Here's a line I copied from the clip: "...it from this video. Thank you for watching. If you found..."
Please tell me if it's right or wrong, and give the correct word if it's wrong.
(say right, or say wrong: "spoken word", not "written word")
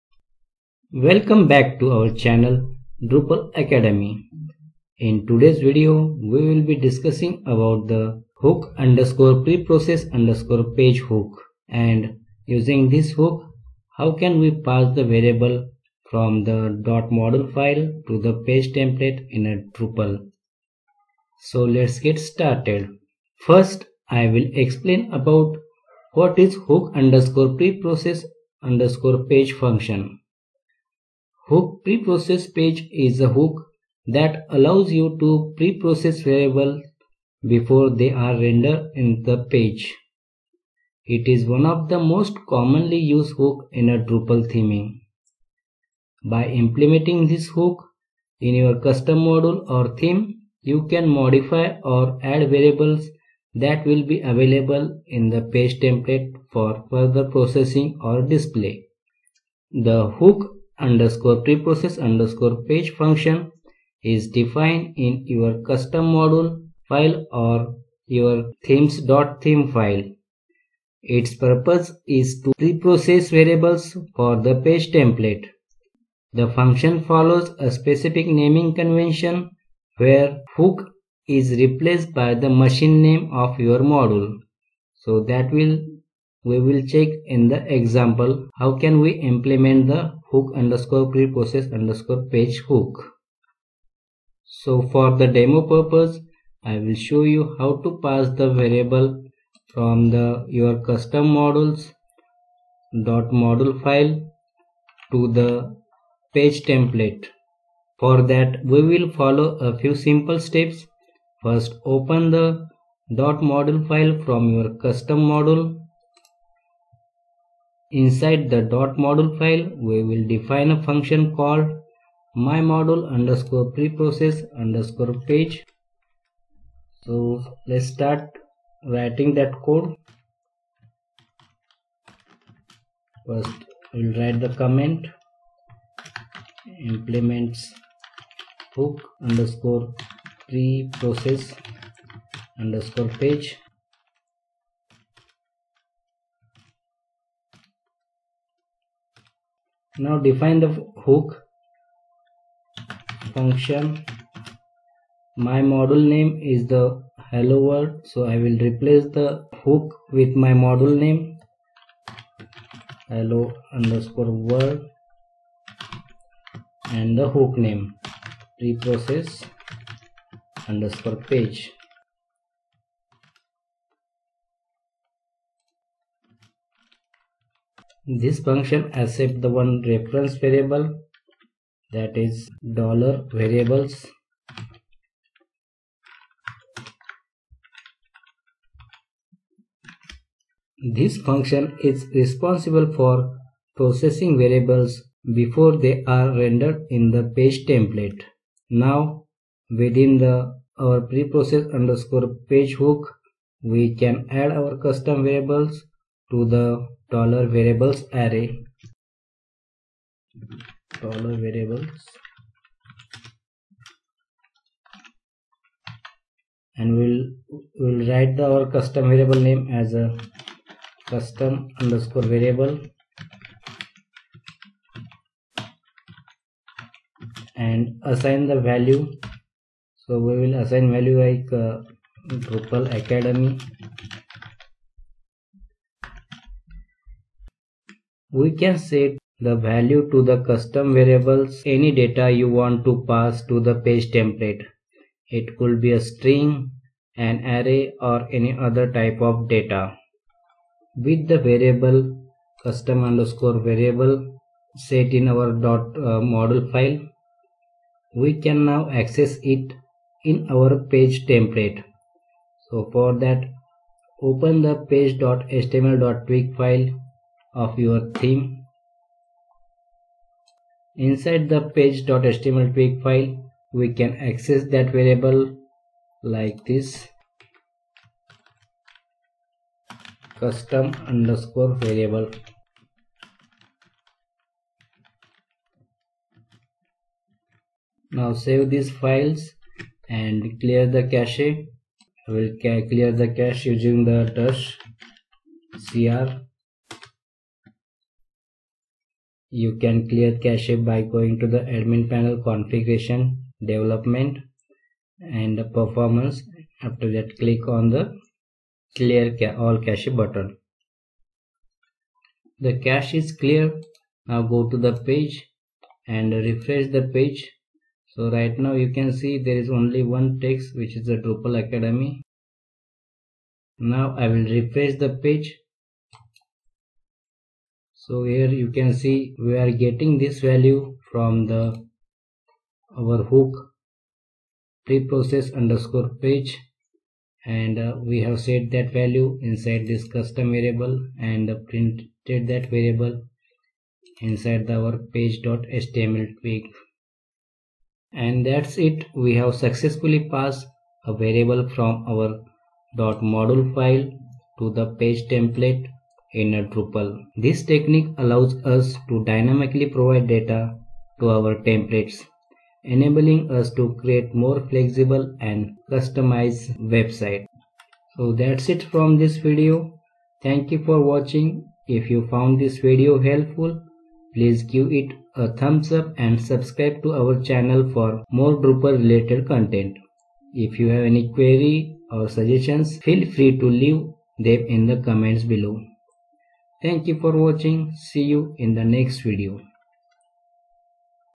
right.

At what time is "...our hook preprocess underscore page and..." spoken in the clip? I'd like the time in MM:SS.
05:33.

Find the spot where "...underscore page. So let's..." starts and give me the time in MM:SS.
02:04.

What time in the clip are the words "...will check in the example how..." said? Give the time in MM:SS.
01:26.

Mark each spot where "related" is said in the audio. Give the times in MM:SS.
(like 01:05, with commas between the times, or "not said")
06:18.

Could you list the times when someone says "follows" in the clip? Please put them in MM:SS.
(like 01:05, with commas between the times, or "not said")
01:17, 01:49.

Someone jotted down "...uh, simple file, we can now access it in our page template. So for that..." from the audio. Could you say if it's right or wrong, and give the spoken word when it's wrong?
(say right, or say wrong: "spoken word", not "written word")
wrong: "module", not "simple".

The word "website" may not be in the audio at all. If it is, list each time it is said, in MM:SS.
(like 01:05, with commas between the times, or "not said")
06:06.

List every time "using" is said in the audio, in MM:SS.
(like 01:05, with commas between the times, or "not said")
00:12, 04:53.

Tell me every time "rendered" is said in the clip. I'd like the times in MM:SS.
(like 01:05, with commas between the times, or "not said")
00:38, 03:16.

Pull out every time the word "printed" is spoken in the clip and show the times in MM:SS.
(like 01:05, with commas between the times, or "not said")
05:41.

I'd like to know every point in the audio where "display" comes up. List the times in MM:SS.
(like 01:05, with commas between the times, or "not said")
00:58.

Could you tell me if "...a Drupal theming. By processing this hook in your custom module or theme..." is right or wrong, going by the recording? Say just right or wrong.
wrong.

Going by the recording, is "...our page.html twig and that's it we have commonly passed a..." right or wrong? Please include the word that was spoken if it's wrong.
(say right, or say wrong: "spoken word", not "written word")
wrong: "successfully", not "commonly".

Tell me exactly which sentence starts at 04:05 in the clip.
It could be a string, an array or any other type of data.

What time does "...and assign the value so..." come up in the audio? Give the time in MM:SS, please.
03:47.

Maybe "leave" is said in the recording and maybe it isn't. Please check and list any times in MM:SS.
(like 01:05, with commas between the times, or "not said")
06:23.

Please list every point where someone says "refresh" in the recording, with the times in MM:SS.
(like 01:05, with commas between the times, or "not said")
05:16, 05:24.